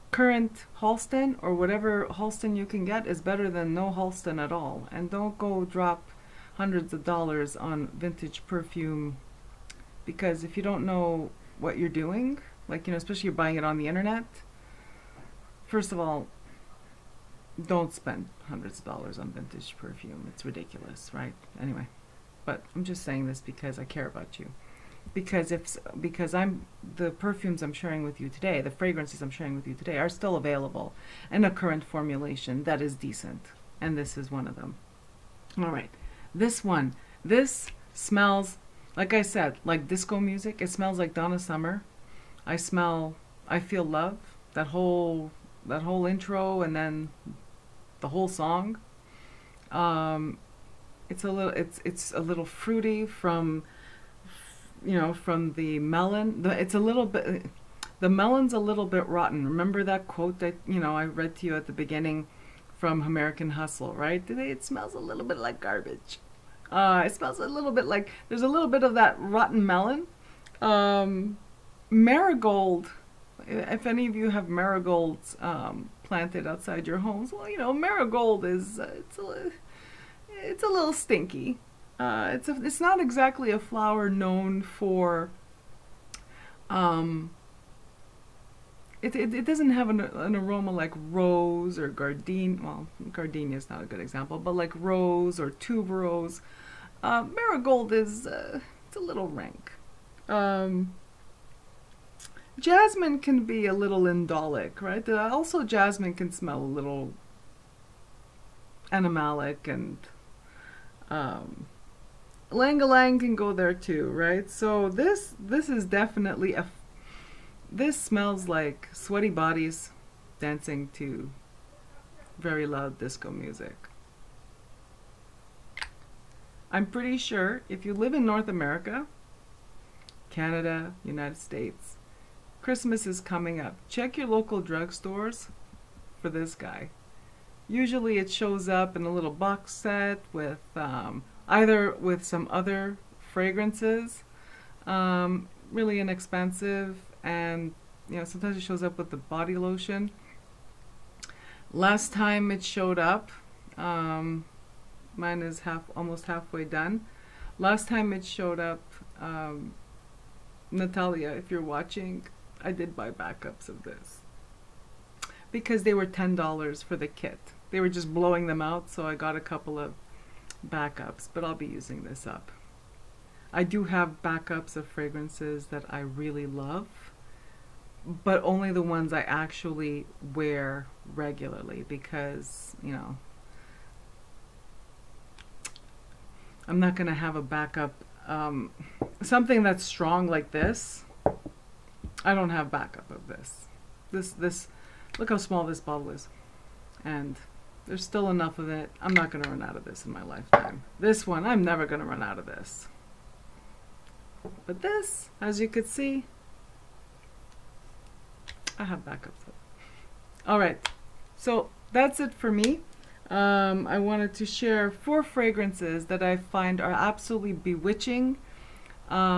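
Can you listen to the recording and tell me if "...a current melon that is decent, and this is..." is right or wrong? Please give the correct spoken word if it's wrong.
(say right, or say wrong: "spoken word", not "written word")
wrong: "formulation", not "melon".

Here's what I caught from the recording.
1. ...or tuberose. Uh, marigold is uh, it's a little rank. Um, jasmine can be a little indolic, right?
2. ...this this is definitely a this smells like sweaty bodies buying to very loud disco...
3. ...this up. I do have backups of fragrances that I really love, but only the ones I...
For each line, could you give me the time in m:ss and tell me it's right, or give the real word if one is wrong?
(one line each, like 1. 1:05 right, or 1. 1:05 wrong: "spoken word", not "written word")
1. 1:35 right
2. 1:54 wrong: "dancing", not "buying"
3. 2:52 right.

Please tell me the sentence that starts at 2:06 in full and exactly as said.
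I'm pretty sure if you live in North America, Canada, United States, Christmas is coming up.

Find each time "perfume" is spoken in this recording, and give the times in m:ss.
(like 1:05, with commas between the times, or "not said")
0:08, 0:19, 0:27.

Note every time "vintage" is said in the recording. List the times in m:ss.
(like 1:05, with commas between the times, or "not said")
0:07, 0:19.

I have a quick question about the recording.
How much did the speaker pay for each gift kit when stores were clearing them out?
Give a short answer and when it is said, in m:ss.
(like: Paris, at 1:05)
$10, at 2:46.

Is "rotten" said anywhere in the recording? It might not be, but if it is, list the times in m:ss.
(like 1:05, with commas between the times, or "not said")
0:59, 1:09.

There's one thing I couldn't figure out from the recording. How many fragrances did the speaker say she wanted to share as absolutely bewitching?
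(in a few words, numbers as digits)
4.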